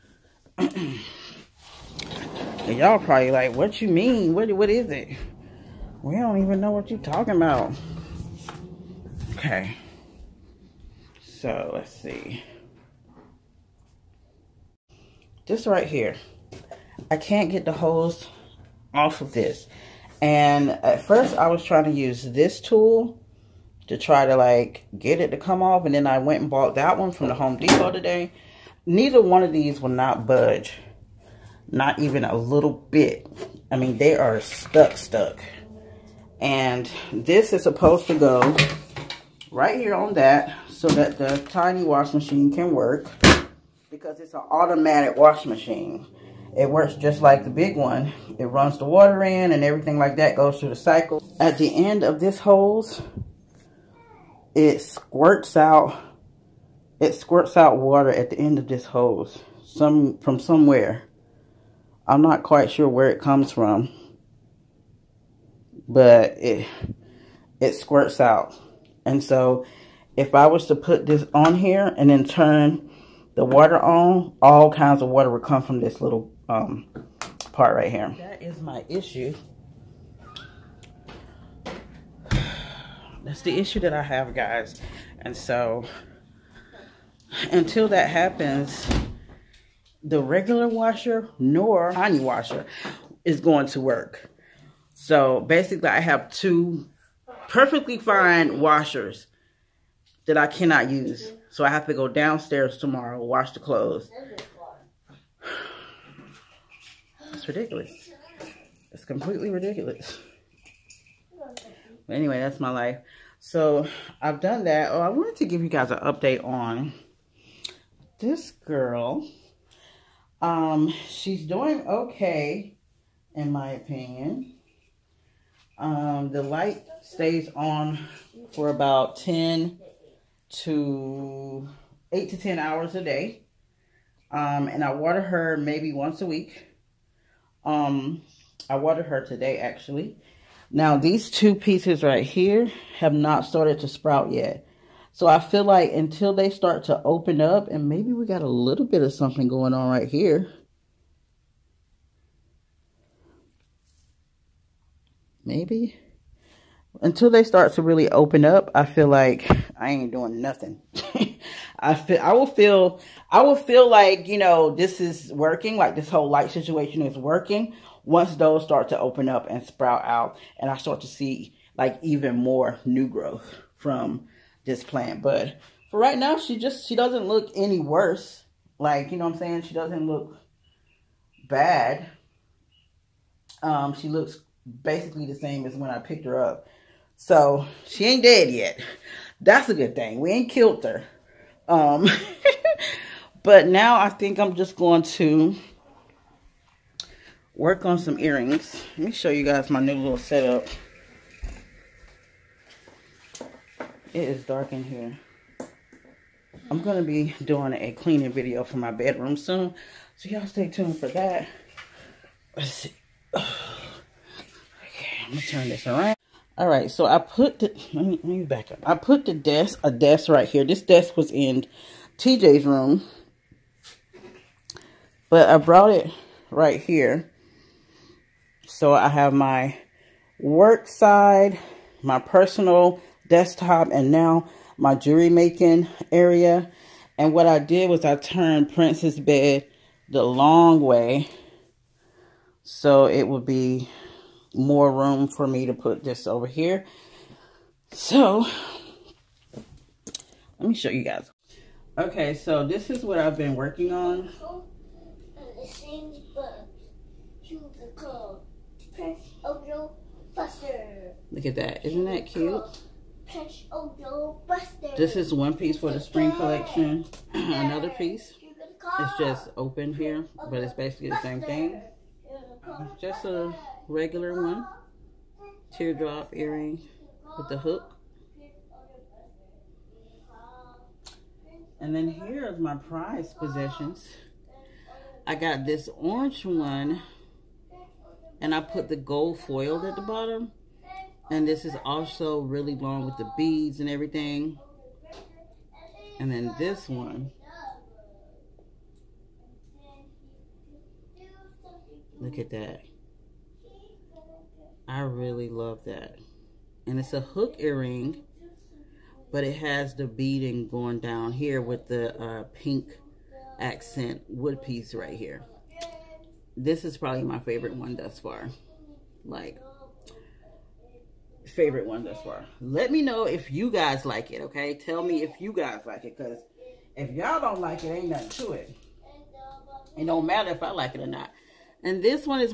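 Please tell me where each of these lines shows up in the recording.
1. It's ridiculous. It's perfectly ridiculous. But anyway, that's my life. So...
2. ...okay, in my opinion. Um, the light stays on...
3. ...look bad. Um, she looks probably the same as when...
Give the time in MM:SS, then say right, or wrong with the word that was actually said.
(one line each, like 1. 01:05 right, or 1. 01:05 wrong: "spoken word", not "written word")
1. 01:47 wrong: "completely", not "perfectly"
2. 02:01 right
3. 03:00 wrong: "basically", not "probably".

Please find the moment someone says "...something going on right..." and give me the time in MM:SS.
02:29.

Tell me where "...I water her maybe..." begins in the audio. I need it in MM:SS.
02:14.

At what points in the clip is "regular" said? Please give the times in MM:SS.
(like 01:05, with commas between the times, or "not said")
01:30, 04:33.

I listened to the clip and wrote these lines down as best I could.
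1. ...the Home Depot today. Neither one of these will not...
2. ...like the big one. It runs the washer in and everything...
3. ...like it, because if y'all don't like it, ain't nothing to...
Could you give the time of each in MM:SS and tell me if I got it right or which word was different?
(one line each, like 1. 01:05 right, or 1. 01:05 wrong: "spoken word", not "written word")
1. 00:27 right
2. 00:47 wrong: "water", not "washer"
3. 05:25 right.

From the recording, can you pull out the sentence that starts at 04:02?
So it would be more room for me to put this over here.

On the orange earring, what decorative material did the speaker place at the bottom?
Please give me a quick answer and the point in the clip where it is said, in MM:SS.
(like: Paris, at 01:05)
gold foil, at 04:48.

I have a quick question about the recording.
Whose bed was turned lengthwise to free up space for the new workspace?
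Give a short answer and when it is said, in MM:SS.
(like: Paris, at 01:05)
Prince's, at 03:58.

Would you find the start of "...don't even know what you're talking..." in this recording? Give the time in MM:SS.
00:06.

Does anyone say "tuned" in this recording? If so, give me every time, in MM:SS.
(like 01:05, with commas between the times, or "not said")
03:30.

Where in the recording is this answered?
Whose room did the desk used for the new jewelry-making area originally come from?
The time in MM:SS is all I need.
03:42.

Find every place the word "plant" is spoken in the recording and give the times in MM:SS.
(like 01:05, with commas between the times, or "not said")
02:54.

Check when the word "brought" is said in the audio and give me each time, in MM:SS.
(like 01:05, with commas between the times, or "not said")
03:45.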